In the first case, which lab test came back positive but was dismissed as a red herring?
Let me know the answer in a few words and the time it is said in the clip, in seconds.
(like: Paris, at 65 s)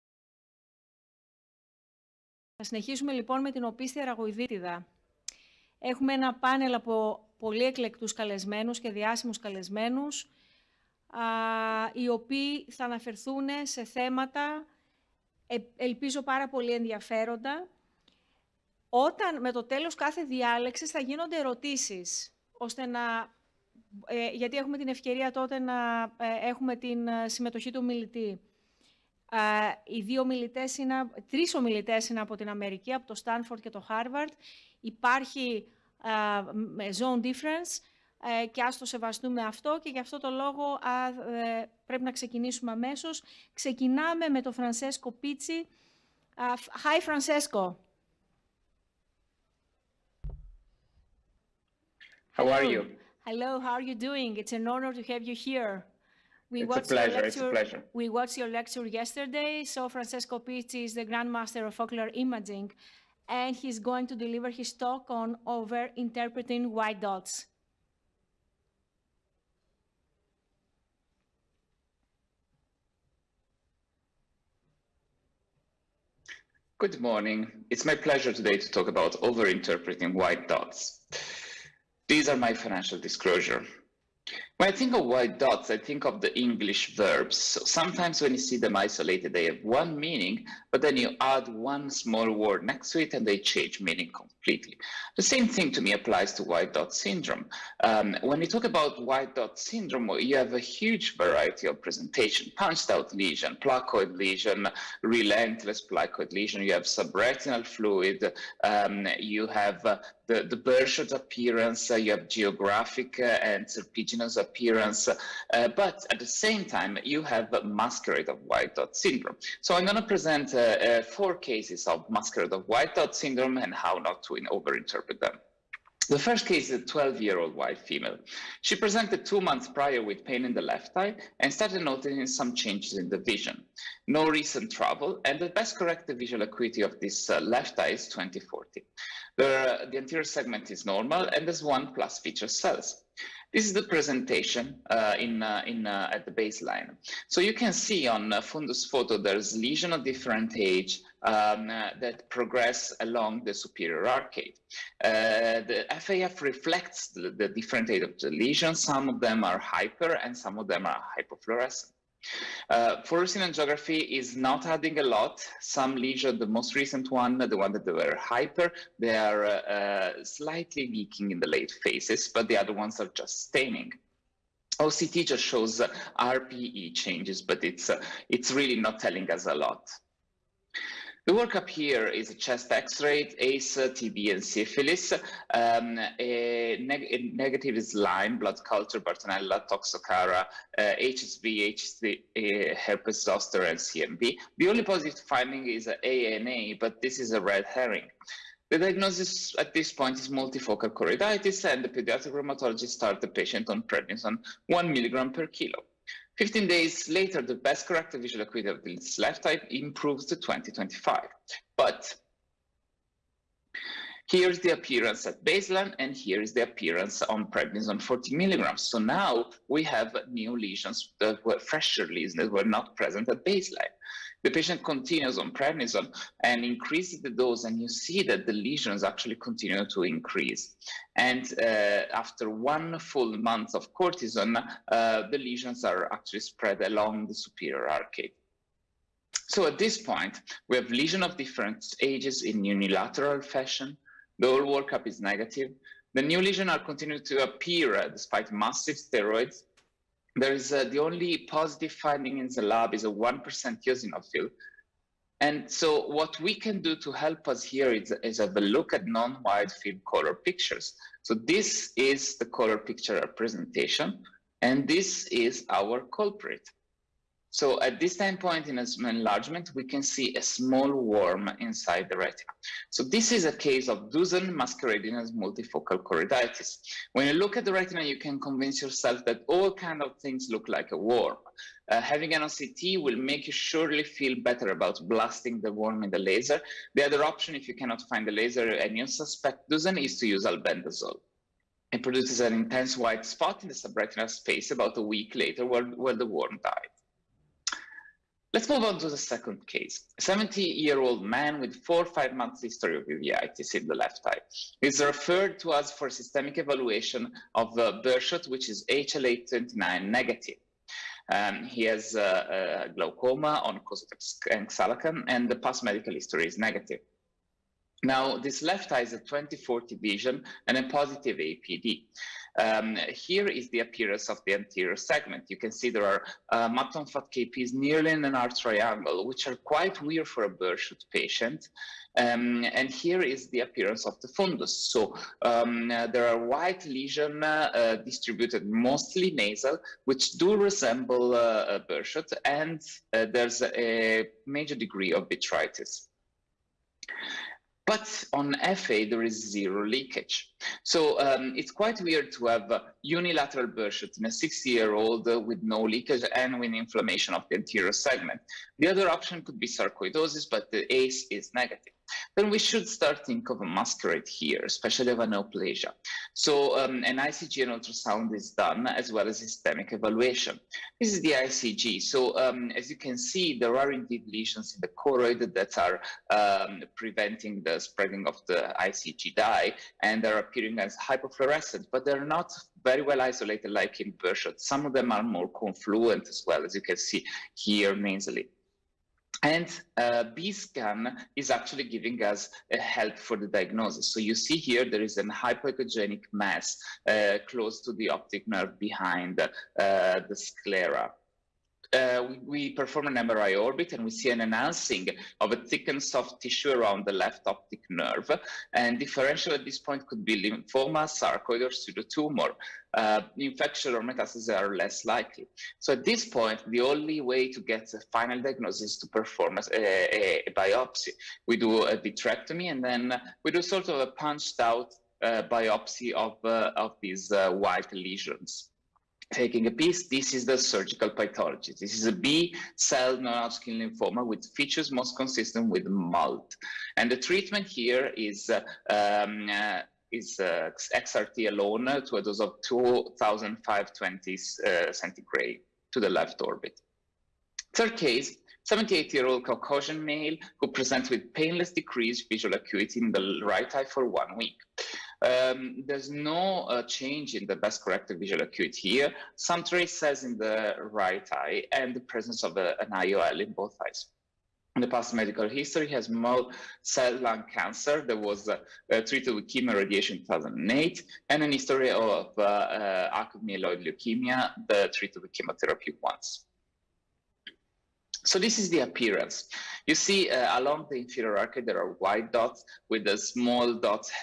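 ANA, at 196 s.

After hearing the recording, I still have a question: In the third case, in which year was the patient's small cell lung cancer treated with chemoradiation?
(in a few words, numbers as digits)
2008.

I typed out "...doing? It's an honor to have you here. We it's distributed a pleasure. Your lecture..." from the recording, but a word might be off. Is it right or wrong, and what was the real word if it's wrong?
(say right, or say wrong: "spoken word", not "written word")
wrong: "watched", not "distributed".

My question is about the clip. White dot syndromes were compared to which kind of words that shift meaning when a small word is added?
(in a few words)
English verbs.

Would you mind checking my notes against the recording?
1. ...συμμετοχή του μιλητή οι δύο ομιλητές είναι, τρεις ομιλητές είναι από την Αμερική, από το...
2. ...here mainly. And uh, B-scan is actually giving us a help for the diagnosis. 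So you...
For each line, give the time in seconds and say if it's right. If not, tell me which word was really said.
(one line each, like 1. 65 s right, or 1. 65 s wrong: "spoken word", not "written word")
1. 27 s right
2. 387 s right.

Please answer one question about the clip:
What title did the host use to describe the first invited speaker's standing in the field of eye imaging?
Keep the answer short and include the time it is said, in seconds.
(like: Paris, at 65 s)
Grandmaster of Ocular Imaging, at 61 s.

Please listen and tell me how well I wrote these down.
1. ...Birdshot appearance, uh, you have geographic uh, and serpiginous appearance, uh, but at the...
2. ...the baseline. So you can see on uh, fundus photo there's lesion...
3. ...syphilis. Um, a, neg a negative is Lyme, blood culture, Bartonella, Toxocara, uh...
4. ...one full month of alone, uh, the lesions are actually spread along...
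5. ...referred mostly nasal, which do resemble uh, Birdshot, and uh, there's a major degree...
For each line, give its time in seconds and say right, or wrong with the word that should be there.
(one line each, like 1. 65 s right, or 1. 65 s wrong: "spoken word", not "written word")
1. 110 s right
2. 146 s right
3. 184 s right
4. 232 s wrong: "cortisone", not "alone"
5. 338 s wrong: "distributed", not "referred".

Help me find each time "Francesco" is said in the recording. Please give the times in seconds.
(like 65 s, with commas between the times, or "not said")
47 s, 59 s.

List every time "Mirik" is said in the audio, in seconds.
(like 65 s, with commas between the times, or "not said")
not said.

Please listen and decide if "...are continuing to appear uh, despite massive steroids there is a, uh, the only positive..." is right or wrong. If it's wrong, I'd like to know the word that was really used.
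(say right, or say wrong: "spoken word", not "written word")
right.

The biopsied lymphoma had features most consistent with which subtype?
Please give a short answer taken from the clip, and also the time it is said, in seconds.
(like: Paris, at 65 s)
MALT, at 435 s.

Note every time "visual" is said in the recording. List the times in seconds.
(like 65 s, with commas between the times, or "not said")
136 s, 208 s, 452 s, 458 s.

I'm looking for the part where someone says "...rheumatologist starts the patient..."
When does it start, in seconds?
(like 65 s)
202 s.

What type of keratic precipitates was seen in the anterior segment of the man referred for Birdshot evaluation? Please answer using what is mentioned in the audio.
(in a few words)
mutton fat KPs.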